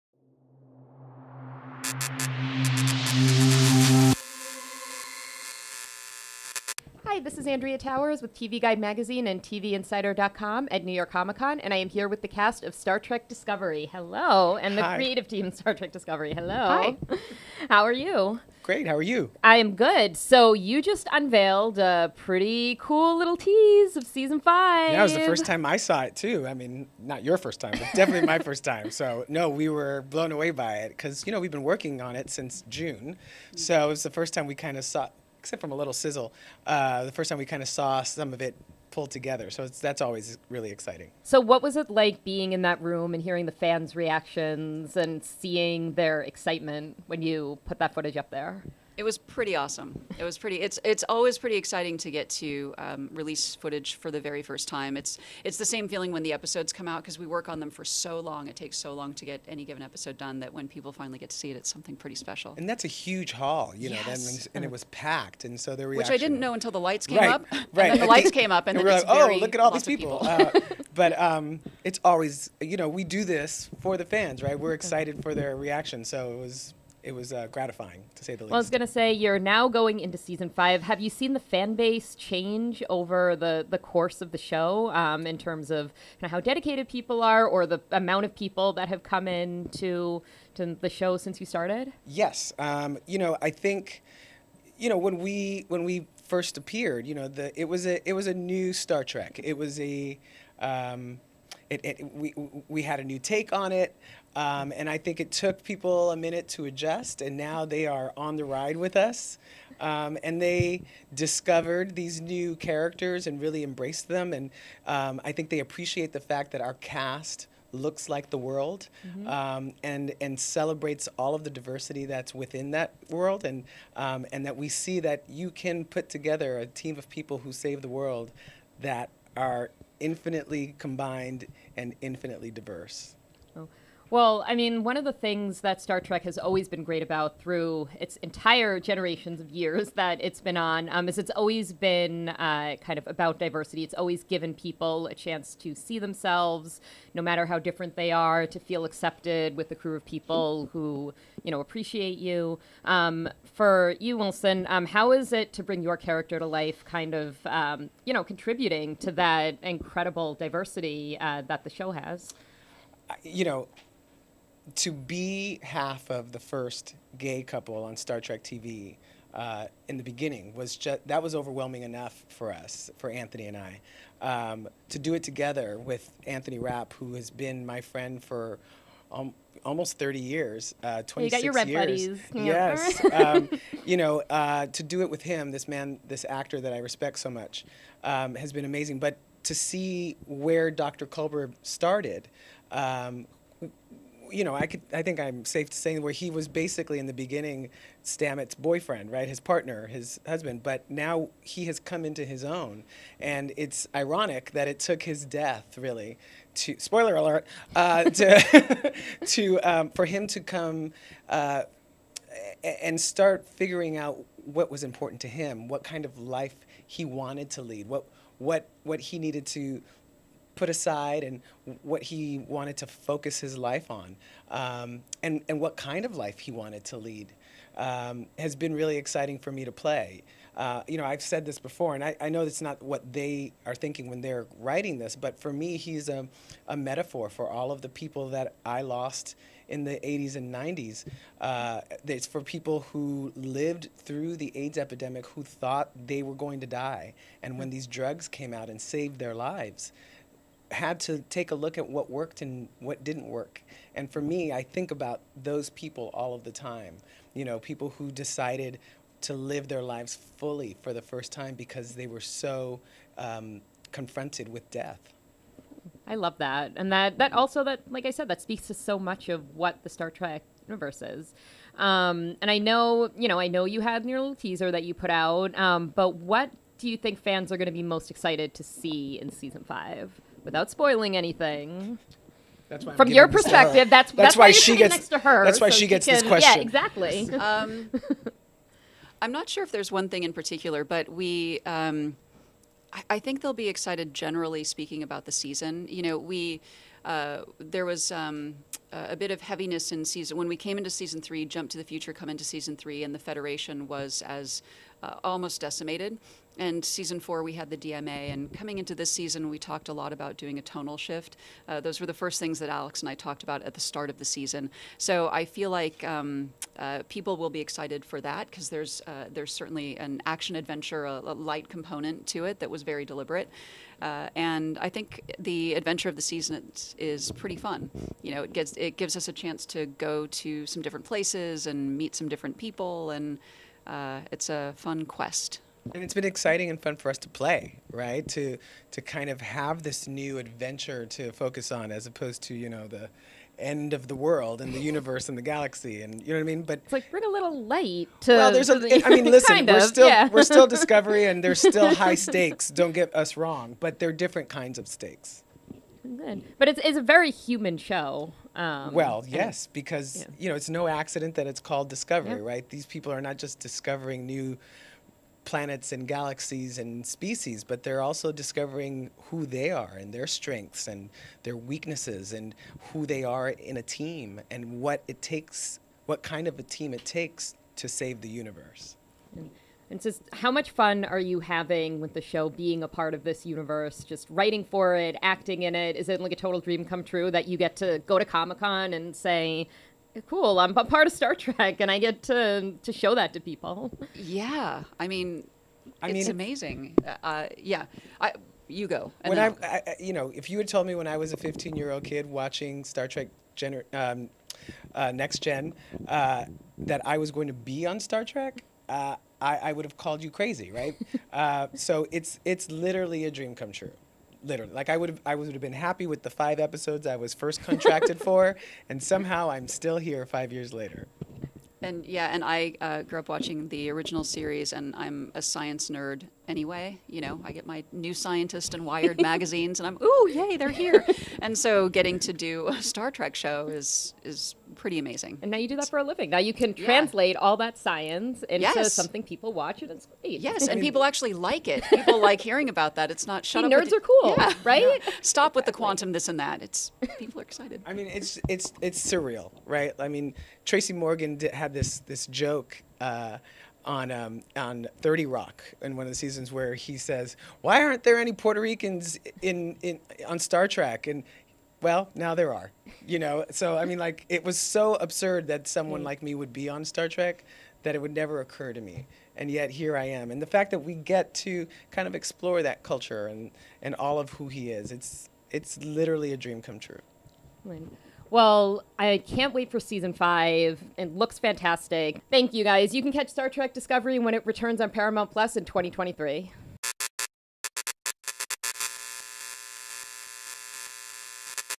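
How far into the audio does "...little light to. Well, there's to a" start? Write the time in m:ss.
5:47.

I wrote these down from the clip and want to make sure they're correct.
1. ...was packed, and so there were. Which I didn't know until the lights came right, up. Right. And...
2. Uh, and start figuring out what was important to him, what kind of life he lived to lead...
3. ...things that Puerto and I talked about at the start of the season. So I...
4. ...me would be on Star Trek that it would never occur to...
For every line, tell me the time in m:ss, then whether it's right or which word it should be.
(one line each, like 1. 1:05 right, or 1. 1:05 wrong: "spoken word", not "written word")
1. 1:04 right
2. 3:31 wrong: "wanted", not "lived"
3. 5:12 wrong: "Alex", not "Puerto"
4. 7:46 right.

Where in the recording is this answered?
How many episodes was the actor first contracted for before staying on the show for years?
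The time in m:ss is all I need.
6:56.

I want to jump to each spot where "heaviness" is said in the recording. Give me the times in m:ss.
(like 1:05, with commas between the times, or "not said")
4:59.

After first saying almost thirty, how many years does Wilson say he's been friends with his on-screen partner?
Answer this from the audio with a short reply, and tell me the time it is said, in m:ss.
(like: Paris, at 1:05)
26, at 3:01.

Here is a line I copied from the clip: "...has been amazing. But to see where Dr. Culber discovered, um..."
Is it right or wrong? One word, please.
wrong.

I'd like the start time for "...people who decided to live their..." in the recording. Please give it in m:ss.
4:17.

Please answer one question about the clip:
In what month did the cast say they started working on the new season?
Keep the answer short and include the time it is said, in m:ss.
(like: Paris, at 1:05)
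June, at 0:32.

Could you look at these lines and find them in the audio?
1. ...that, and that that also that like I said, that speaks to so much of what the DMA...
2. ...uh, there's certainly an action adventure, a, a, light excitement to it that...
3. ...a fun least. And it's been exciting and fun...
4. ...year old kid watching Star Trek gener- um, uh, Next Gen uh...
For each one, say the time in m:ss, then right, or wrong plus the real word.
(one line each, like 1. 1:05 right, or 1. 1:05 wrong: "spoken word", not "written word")
1. 4:26 wrong: "Star", not "DMA"
2. 5:19 wrong: "component", not "excitement"
3. 5:34 wrong: "quest", not "least"
4. 6:41 right.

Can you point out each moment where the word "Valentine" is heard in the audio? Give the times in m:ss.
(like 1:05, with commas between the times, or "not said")
not said.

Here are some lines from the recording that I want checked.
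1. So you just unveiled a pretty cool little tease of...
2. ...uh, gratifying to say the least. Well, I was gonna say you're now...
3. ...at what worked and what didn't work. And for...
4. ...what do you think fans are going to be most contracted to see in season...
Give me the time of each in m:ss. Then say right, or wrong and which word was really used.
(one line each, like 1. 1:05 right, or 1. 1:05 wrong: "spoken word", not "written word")
1. 0:20 right
2. 1:17 right
3. 4:11 right
4. 4:36 wrong: "excited", not "contracted".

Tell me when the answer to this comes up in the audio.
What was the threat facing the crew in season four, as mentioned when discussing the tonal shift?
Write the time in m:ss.
5:07.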